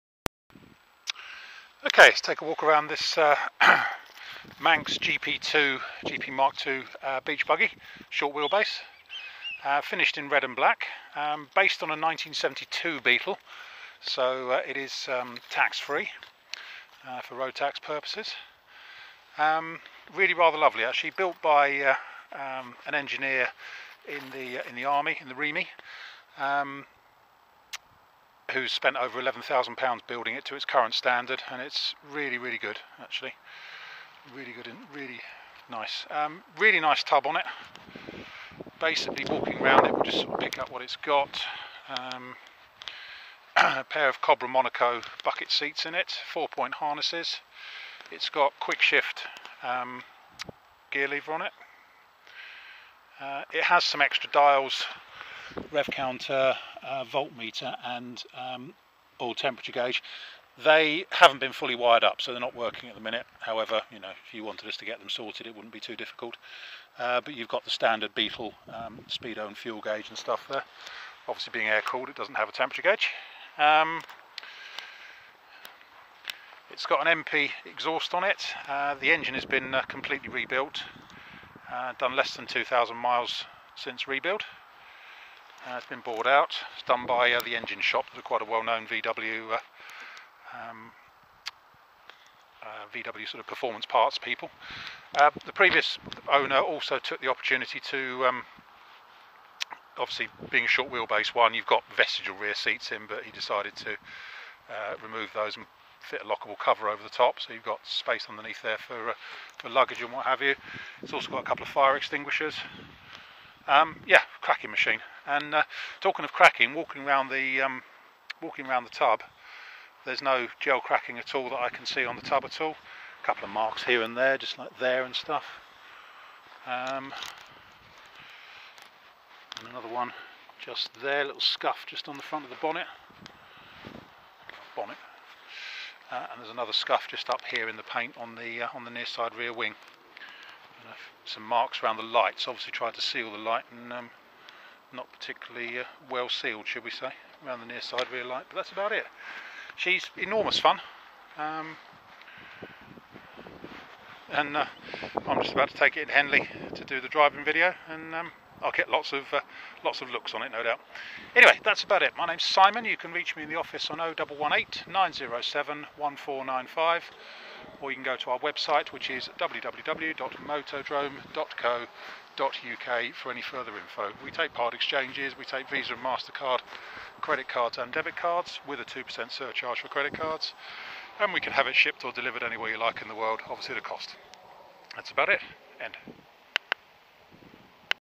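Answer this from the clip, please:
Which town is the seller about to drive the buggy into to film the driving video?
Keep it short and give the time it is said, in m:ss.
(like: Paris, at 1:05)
Henley, at 2:36.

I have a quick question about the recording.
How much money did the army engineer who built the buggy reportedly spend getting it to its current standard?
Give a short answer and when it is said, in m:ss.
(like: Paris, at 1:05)
£11,000, at 0:29.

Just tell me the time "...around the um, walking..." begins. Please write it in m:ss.
1:57.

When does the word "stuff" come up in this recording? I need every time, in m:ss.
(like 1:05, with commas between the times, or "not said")
1:10, 2:05.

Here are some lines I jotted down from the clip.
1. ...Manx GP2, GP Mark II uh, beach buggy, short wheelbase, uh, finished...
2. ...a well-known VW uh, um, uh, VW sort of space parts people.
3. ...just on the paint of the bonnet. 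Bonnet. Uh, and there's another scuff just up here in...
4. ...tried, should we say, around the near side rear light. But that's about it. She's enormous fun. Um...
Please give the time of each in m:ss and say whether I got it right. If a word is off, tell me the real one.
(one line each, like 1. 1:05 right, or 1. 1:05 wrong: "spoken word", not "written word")
1. 0:04 right
2. 1:28 wrong: "performance", not "space"
3. 2:11 wrong: "front", not "paint"
4. 2:26 wrong: "sealed", not "tried".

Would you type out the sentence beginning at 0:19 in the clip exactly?
Um, really rather lovely, actually, built by uh, um, an engineer in the in the army in the REMI.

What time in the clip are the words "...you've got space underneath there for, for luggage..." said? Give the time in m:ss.
1:47.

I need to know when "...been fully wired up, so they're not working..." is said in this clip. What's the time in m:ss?
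1:01.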